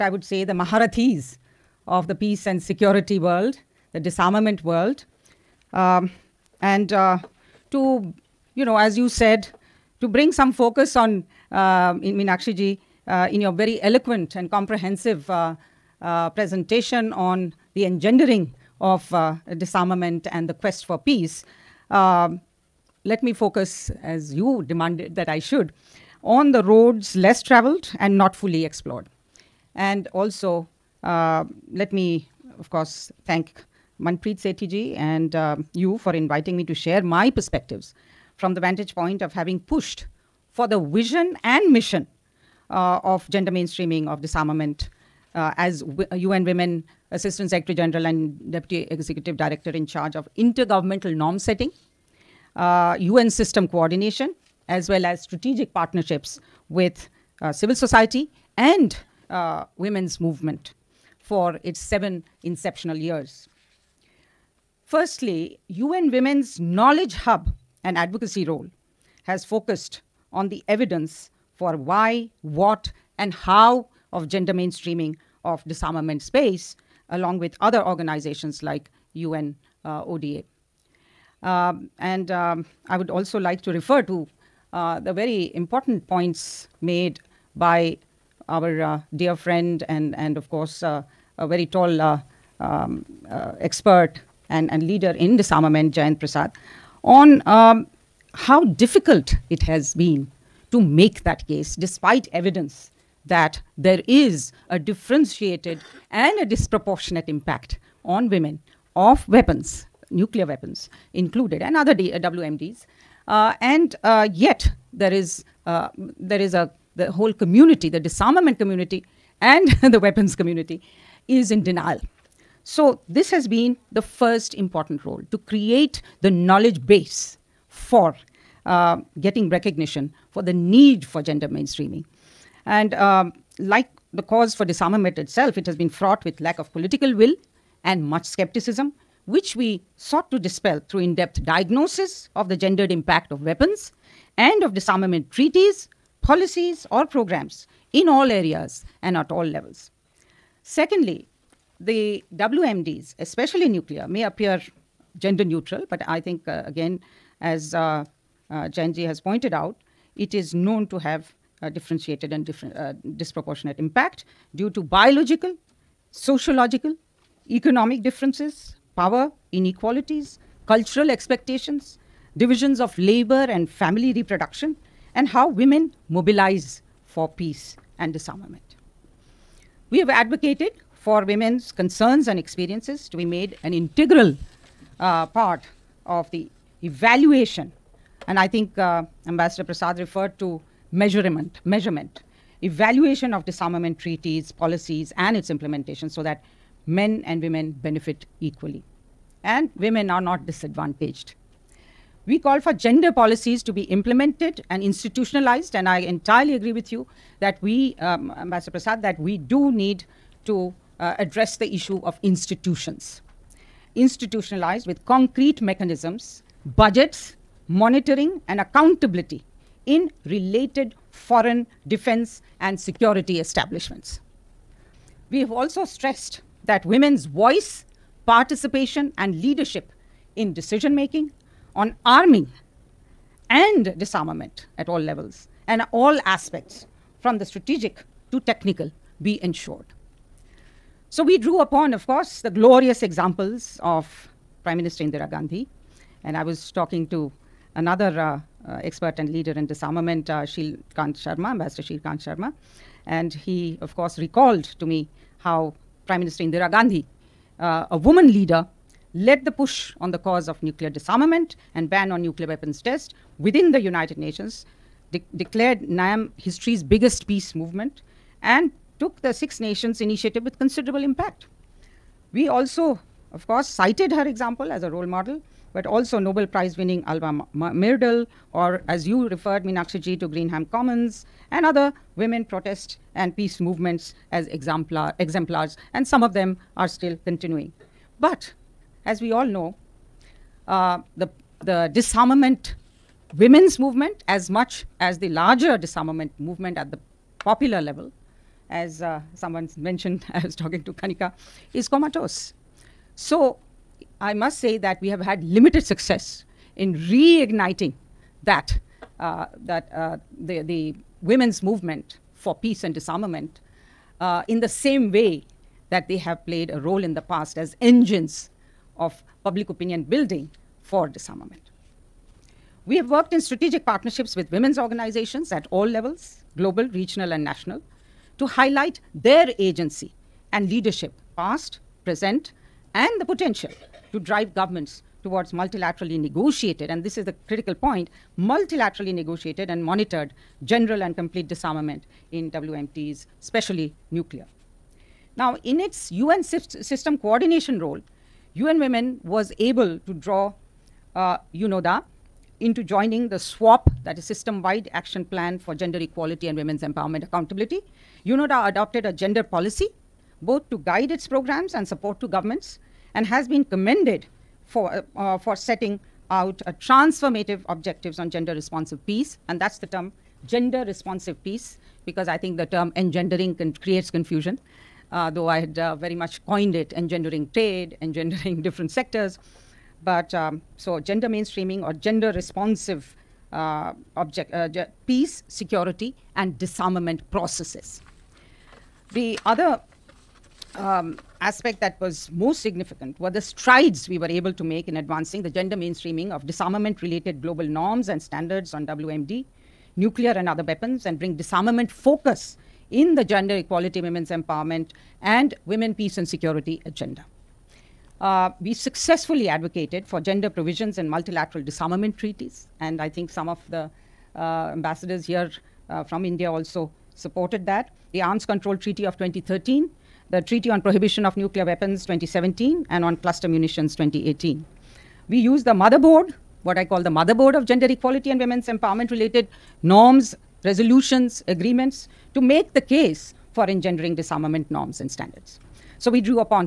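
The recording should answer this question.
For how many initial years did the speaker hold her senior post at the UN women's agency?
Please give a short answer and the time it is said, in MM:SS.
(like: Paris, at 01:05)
7, at 01:01.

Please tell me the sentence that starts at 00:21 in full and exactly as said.
Um, let me focus, as you demanded that I should, on the roads less traveled and not fully explored.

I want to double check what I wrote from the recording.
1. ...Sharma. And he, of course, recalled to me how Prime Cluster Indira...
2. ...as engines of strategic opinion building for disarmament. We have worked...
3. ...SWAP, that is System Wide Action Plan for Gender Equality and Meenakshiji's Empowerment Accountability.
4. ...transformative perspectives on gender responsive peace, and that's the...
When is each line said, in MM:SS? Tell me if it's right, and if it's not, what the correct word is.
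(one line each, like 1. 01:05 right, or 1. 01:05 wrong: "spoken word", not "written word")
1. 04:12 wrong: "Minister", not "Cluster"
2. 05:17 wrong: "public", not "strategic"
3. 05:53 wrong: "Women", not "Meenakshiji"
4. 06:06 wrong: "objectives", not "perspectives".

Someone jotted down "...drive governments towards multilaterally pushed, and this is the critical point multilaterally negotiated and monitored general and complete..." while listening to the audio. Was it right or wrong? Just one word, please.
wrong.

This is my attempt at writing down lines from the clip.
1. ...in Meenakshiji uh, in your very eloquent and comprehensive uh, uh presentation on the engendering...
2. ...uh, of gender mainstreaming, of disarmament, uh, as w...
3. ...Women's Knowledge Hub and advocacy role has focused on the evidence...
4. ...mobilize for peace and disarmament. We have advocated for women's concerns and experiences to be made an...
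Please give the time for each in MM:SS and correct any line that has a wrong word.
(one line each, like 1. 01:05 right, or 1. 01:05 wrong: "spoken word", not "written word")
1. 00:12 right
2. 00:42 right
3. 01:06 right
4. 02:56 right.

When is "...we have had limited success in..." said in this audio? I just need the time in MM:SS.
05:05.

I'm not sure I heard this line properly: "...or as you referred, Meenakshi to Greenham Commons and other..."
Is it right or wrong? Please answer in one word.
right.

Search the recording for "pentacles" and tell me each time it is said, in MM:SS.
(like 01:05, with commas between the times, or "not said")
not said.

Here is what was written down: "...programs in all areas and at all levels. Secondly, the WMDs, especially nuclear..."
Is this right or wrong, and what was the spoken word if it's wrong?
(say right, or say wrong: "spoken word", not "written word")
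right.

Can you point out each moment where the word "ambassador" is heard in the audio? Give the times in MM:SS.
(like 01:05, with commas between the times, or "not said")
03:09, 03:28, 04:11, 06:54.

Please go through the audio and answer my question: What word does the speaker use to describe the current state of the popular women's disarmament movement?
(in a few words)
comatose.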